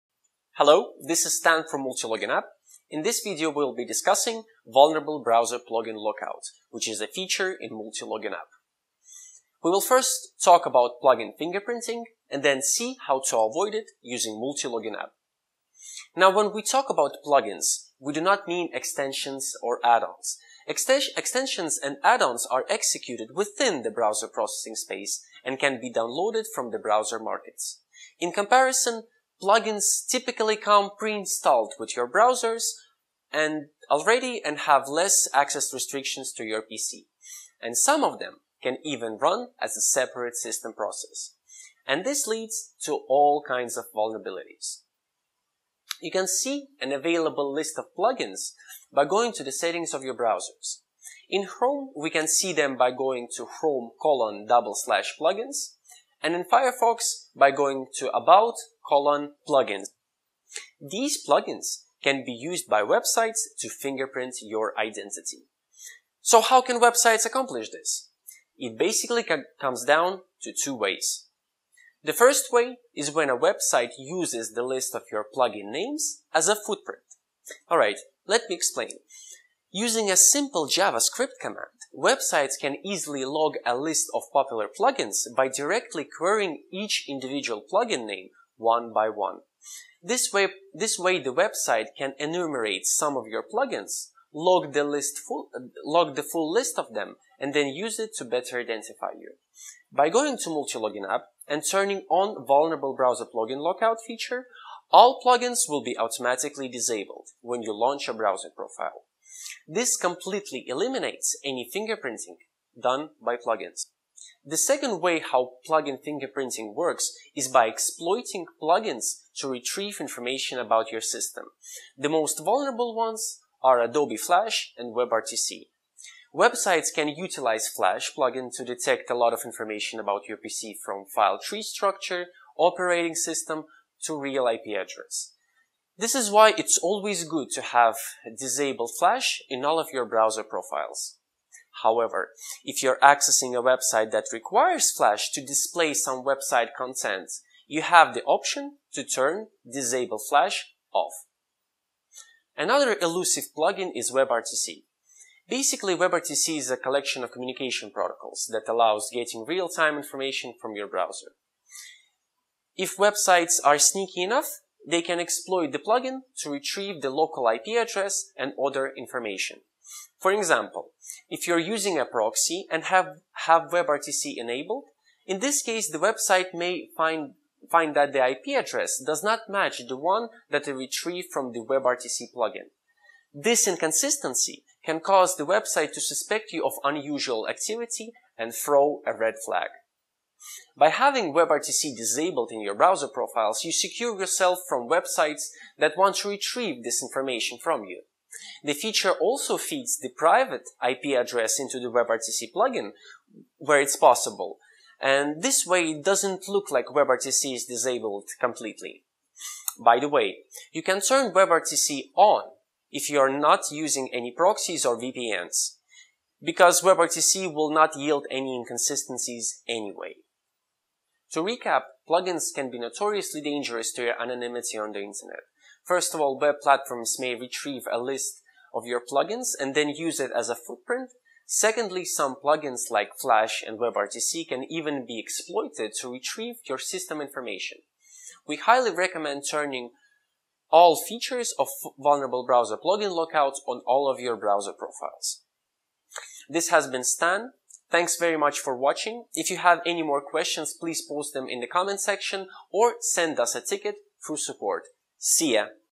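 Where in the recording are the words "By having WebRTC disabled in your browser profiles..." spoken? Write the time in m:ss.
3:10.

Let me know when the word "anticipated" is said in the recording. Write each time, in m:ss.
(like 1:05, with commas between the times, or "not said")
not said.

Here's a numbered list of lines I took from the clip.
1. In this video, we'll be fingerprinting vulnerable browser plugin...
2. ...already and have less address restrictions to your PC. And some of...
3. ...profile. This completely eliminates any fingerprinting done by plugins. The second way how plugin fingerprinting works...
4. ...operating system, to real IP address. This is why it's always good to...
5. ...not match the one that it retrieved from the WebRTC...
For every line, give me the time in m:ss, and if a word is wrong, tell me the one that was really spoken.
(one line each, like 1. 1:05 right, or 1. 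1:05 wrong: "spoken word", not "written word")
1. 0:02 wrong: "discussing", not "fingerprinting"
2. 0:33 wrong: "access", not "address"
3. 1:48 right
4. 2:12 right
5. 2:59 right.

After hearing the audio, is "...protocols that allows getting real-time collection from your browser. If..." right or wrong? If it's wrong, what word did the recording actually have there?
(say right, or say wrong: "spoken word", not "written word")
wrong: "information", not "collection".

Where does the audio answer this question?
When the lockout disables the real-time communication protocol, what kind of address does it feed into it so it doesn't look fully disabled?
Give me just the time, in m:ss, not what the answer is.
3:20.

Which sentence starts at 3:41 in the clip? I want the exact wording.
To recap, plugins can be notoriously dangerous to your anonymity on the internet.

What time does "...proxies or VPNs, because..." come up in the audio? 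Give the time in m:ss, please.
3:34.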